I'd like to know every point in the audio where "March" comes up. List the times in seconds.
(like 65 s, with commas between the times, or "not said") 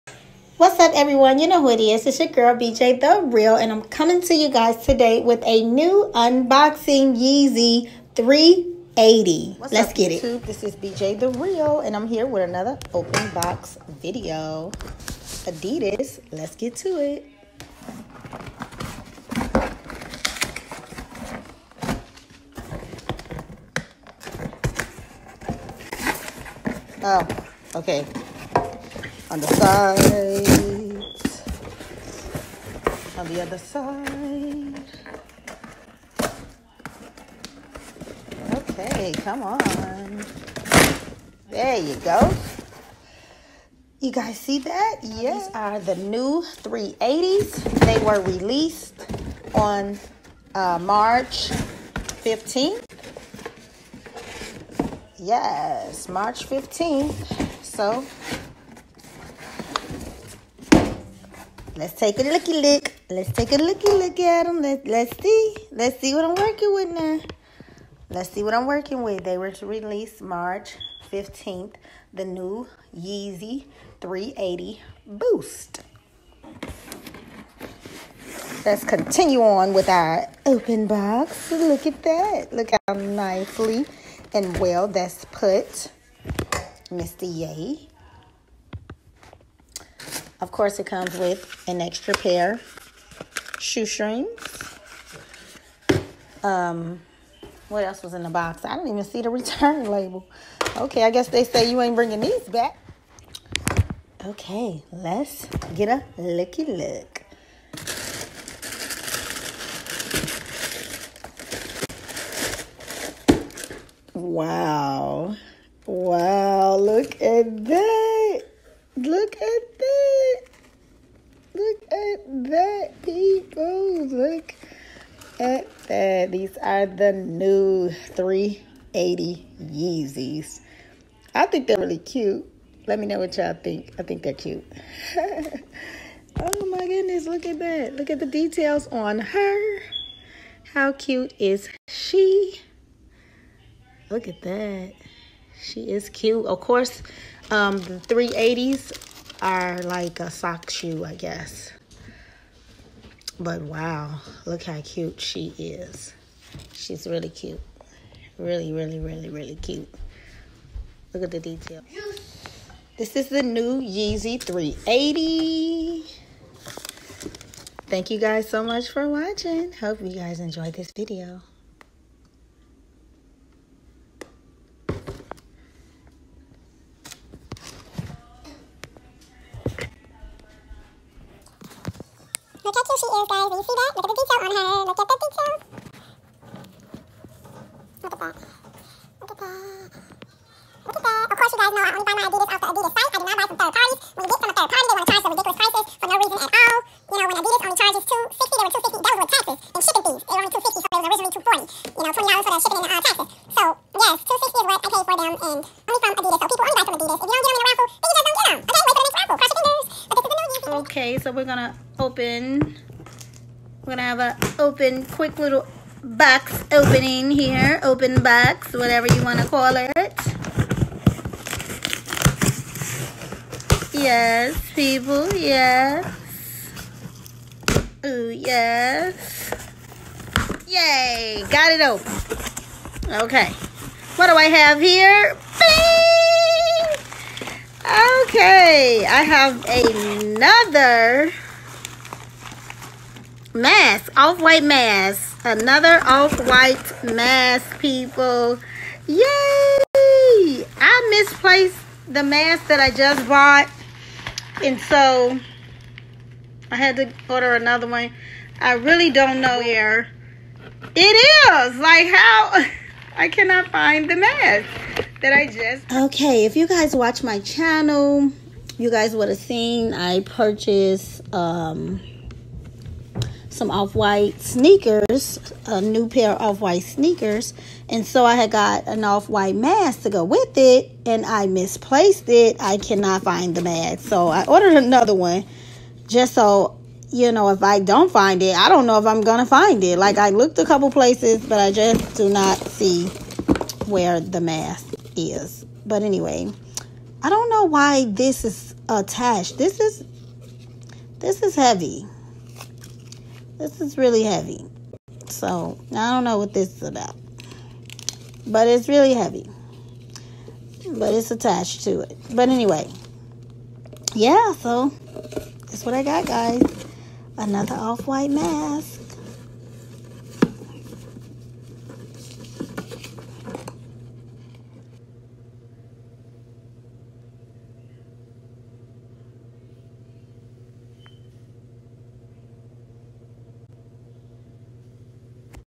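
50 s, 56 s, 70 s.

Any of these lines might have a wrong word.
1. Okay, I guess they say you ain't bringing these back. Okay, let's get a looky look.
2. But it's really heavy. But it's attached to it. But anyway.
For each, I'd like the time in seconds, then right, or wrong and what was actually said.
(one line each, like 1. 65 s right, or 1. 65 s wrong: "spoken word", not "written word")
1. 100 s right
2. 308 s right.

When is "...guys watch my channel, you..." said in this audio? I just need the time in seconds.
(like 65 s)
266 s.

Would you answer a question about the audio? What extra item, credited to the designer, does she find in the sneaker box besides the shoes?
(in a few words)
shoestrings.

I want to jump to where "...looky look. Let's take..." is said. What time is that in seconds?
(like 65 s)
62 s.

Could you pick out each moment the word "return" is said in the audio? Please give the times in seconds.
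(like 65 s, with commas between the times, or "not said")
99 s.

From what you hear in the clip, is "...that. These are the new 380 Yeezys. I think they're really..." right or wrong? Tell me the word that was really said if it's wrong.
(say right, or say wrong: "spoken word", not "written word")
right.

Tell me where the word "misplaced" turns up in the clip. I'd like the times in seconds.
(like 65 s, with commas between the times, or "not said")
251 s, 281 s.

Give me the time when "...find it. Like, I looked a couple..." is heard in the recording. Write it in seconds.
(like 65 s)
289 s.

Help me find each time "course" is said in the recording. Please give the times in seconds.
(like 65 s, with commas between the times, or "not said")
90 s, 146 s, 191 s.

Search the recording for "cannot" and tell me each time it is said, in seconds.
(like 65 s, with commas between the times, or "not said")
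263 s, 282 s.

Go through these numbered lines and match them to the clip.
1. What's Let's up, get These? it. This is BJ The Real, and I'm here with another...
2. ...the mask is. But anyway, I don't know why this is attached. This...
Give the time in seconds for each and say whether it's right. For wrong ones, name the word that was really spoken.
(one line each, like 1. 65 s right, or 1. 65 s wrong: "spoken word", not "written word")
1. 9 s wrong: "YouTube", not "These"
2. 294 s right.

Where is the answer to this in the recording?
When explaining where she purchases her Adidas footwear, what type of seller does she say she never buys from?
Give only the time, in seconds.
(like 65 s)
193 s.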